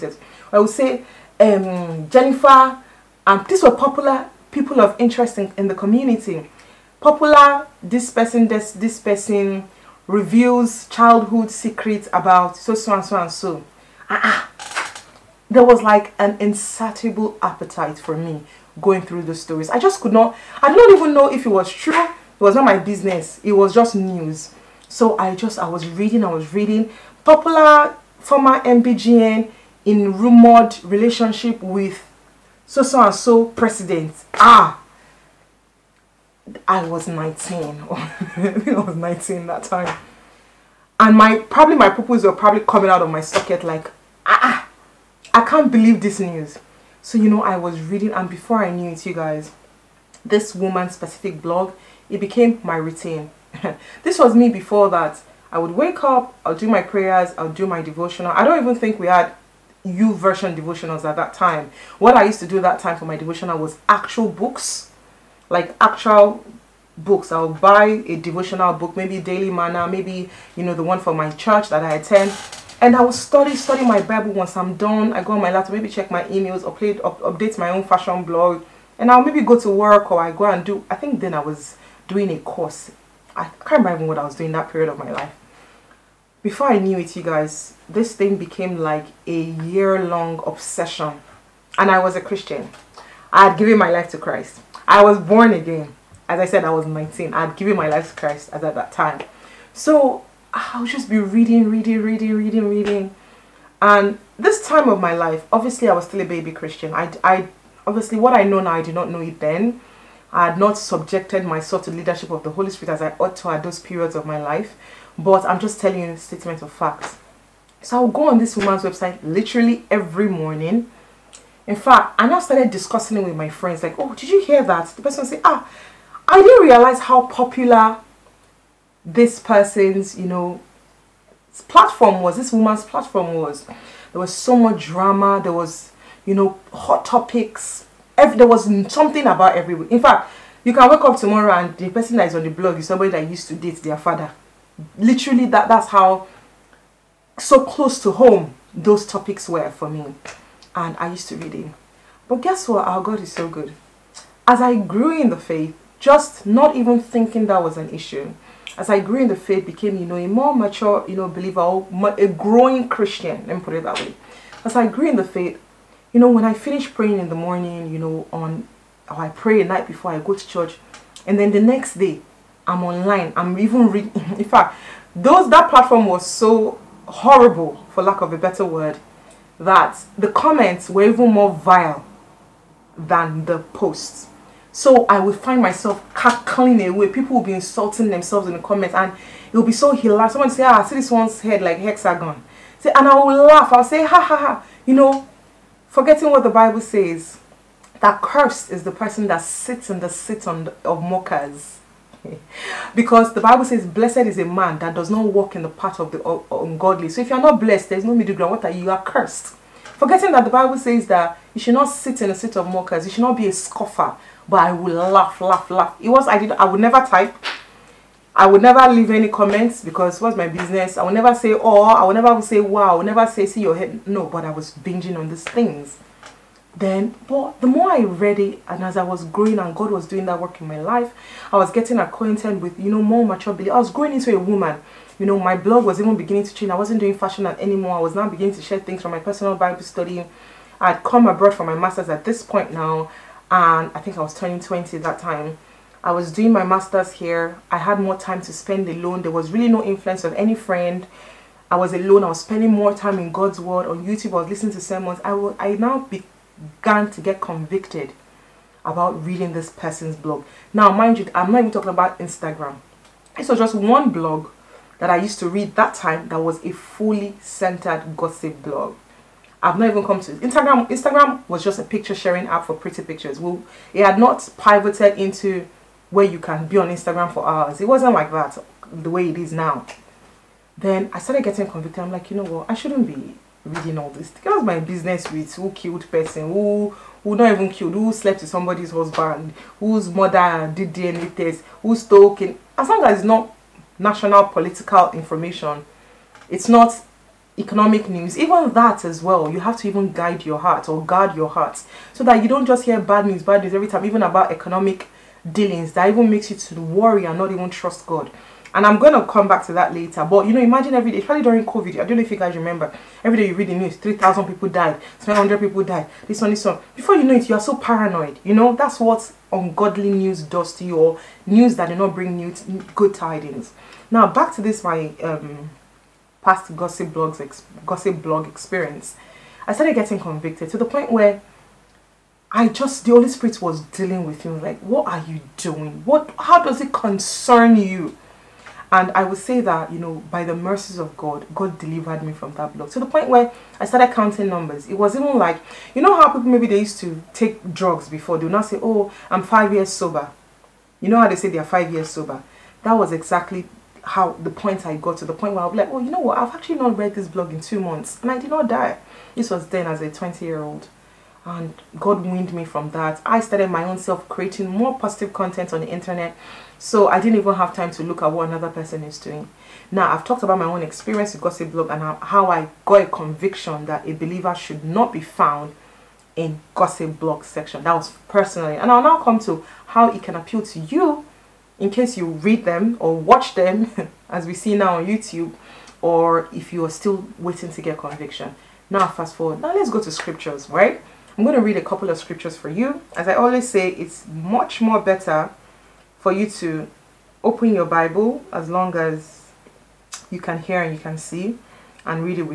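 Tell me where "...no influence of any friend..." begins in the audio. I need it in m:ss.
4:09.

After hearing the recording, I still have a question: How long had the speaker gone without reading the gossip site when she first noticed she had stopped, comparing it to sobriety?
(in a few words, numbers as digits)
Two months.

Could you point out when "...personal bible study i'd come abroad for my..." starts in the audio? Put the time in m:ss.
3:59.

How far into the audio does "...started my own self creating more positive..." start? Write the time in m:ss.
6:03.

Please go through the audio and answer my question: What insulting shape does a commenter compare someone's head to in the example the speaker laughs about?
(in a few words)
Hexagon.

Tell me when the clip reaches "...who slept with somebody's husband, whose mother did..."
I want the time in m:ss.
4:47.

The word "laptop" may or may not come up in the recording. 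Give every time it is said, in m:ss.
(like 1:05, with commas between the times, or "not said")
1:15.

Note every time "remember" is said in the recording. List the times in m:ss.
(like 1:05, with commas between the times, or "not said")
1:23, 5:12.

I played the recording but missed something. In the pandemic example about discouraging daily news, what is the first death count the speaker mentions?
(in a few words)
3,000.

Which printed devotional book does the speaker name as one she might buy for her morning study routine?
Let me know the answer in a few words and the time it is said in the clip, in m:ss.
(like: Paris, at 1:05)
Daily Manna, at 1:09.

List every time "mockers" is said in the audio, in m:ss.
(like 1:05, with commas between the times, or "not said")
3:21, 3:32.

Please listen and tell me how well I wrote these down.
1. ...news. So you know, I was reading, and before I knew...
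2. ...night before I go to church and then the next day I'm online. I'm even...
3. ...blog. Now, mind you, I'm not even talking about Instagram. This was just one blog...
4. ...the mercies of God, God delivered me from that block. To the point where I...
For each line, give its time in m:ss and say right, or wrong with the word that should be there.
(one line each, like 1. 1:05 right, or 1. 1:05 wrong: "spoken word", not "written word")
1. 0:46 right
2. 2:49 right
3. 4:20 right
4. 5:40 right.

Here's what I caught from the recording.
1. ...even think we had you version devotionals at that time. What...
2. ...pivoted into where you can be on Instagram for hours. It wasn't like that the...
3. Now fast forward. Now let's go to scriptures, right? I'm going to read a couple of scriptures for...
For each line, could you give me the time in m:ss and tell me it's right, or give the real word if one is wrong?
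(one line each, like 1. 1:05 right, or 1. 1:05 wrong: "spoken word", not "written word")
1. 0:58 right
2. 4:34 right
3. 6:28 right.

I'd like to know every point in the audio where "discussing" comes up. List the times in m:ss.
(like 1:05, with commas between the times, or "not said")
2:02.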